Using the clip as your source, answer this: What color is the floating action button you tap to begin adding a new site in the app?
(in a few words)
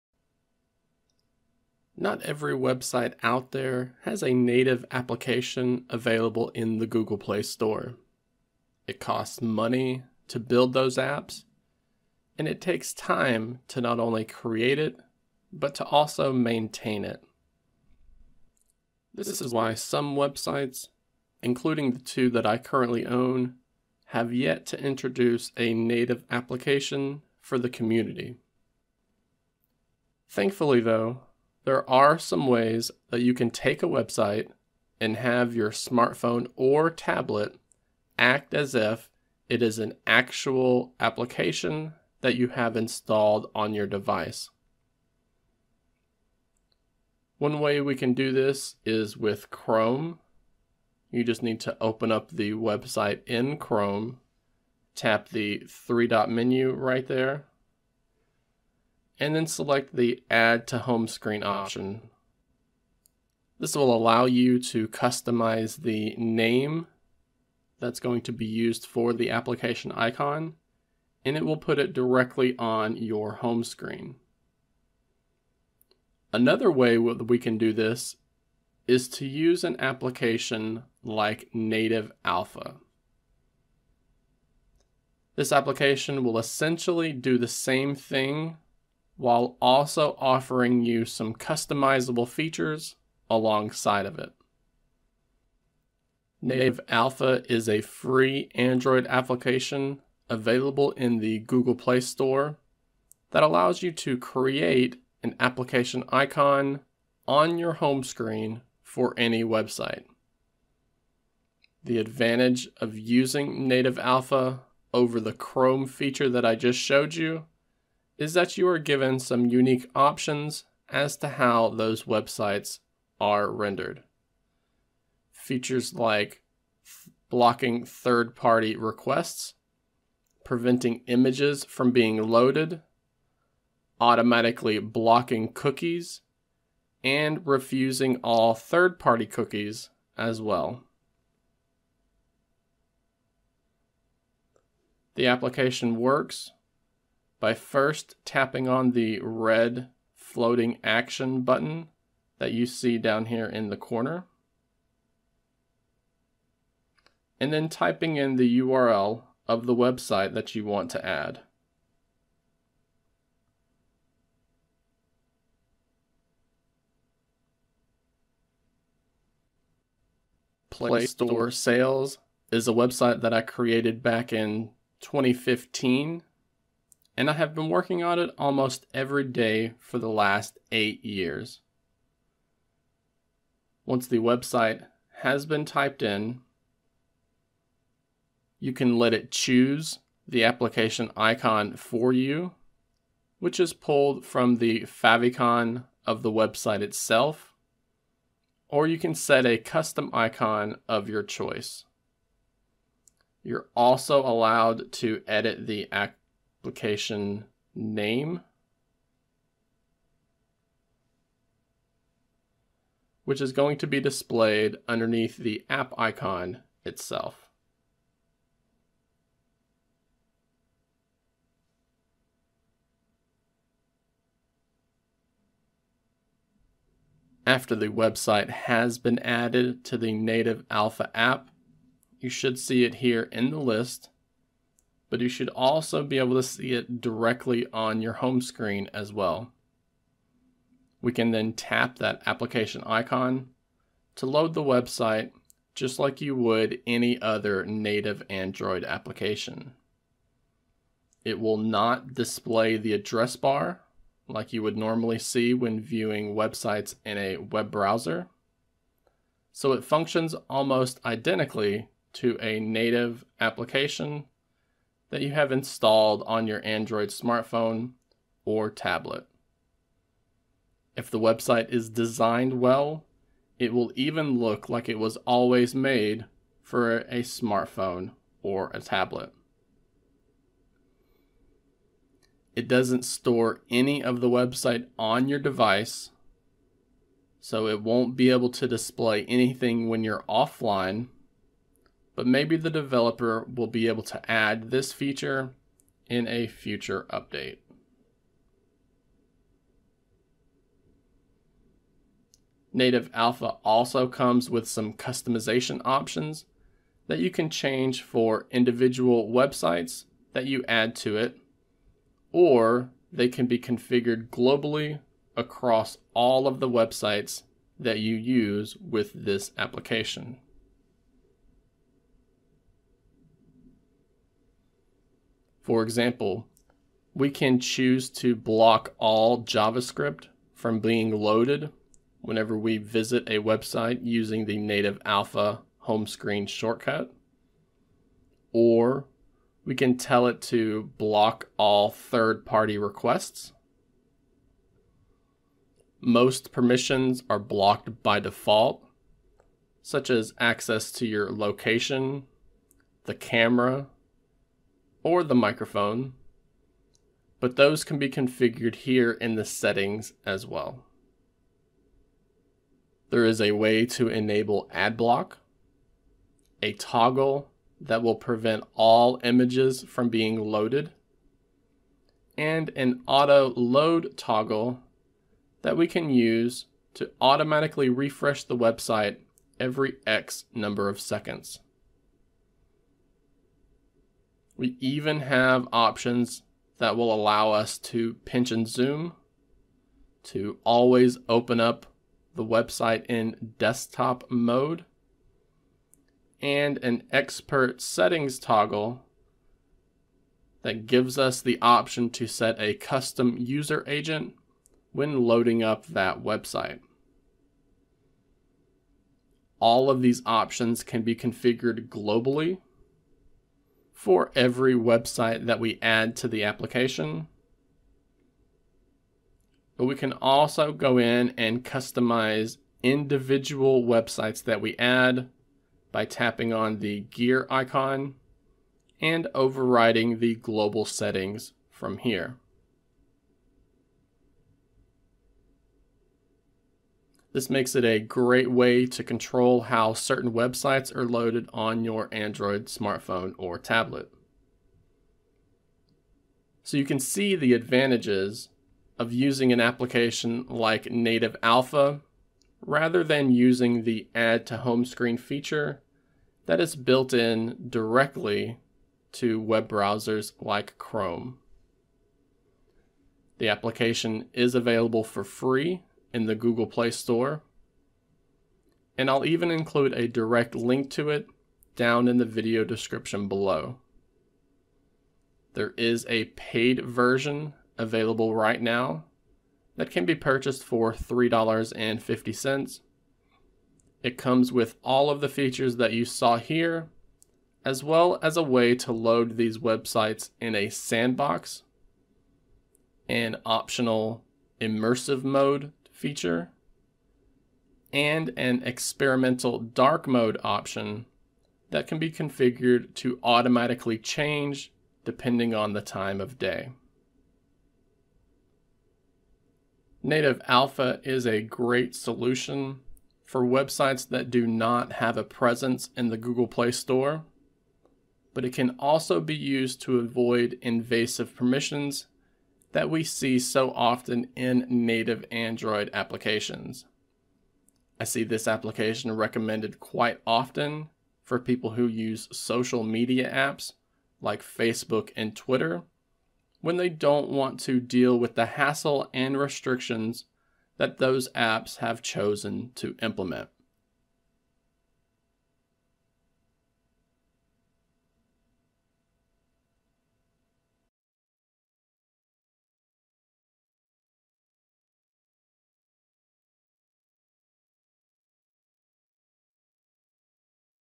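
red.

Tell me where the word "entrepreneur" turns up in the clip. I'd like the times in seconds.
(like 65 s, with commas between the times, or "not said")
not said.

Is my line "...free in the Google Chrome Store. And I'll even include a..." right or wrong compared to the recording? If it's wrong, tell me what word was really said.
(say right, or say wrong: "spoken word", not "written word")
wrong: "Play", not "Chrome".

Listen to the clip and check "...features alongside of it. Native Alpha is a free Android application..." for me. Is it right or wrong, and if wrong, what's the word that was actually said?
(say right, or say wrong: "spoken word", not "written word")
right.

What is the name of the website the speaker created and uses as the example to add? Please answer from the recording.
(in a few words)
Play Store Sales.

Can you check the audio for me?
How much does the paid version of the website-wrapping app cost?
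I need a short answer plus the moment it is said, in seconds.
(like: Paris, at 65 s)
$3.50, at 480 s.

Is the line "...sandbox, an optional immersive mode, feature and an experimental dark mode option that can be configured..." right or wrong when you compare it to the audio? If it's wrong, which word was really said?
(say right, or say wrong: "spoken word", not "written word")
right.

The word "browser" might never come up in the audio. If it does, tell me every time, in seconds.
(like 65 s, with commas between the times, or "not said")
257 s, 459 s.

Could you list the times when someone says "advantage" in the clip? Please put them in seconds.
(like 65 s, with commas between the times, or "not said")
111 s, 447 s.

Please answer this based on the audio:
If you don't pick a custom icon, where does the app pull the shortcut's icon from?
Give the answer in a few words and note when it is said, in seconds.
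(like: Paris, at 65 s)
the favicon, at 194 s.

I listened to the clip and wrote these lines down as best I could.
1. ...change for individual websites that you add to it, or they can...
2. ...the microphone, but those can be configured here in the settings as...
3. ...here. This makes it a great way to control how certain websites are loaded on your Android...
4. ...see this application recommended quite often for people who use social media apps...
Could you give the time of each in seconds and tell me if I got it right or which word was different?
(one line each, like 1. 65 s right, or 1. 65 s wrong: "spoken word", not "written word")
1. 307 s right
2. 355 s right
3. 431 s right
4. 528 s right.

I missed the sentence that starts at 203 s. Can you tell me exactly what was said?
You're also allowed to edit the application name, which is going to be displayed underneath the app icon itself.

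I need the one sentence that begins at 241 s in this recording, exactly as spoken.
We can then tap that application icon to load the website just like you would any other native Android application.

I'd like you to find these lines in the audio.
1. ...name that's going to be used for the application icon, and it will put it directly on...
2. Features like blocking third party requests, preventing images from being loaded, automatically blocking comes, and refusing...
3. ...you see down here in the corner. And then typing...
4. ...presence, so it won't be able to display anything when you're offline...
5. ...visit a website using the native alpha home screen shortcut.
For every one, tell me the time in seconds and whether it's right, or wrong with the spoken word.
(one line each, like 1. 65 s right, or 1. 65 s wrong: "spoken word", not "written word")
1. 66 s right
2. 125 s wrong: "cookies", not "comes"
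3. 152 s right
4. 285 s wrong: "device", not "presence"
5. 332 s right.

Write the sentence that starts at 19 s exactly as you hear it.
This is why some websites, including the two that I currently own, have yet to introduce a native application for the community.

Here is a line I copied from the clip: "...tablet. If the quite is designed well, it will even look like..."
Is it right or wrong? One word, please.
wrong.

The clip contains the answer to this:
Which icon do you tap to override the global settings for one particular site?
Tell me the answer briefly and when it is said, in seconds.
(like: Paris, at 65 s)
gear icon, at 427 s.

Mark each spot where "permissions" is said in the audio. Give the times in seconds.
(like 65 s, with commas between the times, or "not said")
346 s, 521 s.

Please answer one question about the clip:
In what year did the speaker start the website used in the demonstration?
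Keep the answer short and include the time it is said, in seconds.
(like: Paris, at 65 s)
2015, at 175 s.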